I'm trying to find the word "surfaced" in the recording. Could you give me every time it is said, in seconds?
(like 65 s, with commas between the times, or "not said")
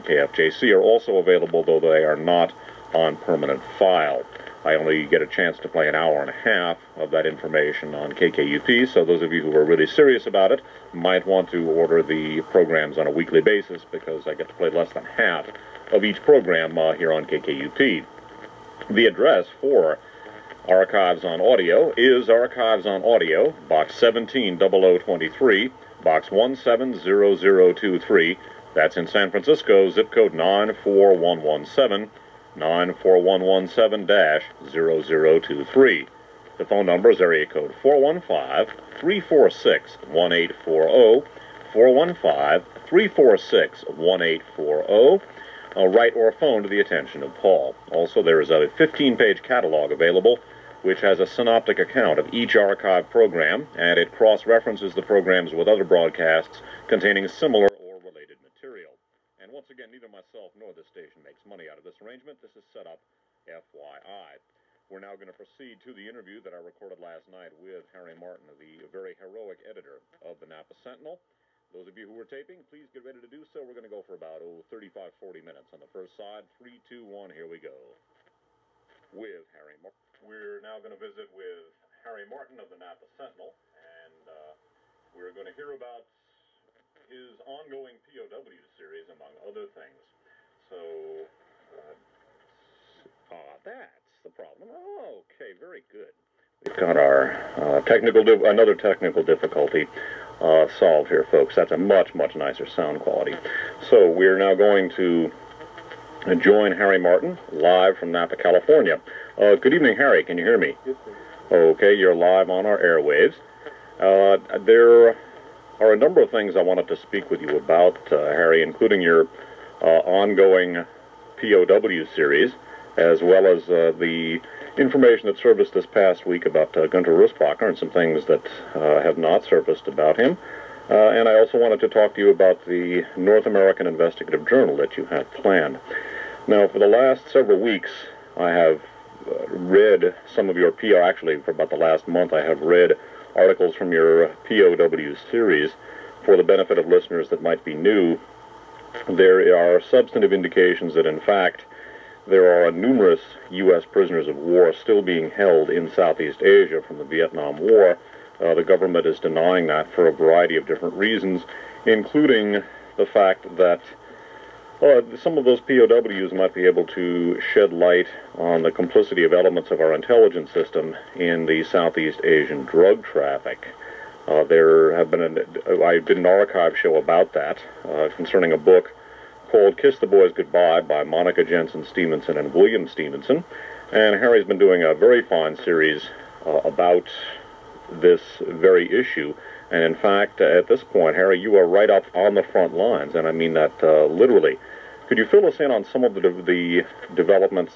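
125 s, 129 s.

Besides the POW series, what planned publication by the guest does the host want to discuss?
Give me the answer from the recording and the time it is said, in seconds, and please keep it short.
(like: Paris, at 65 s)
North American Investigative Journal, at 133 s.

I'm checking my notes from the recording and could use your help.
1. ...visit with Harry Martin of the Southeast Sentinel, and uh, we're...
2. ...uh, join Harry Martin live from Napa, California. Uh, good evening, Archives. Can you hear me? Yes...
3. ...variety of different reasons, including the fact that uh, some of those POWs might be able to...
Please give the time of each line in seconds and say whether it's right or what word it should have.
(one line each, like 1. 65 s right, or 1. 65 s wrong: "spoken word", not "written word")
1. 80 s wrong: "Napa", not "Southeast"
2. 106 s wrong: "Harry", not "Archives"
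3. 160 s right.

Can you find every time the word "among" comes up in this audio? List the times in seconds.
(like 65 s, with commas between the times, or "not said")
89 s.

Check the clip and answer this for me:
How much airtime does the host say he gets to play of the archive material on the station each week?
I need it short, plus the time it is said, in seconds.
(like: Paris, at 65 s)
an hour and a half, at 5 s.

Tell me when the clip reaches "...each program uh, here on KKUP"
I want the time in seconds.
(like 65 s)
16 s.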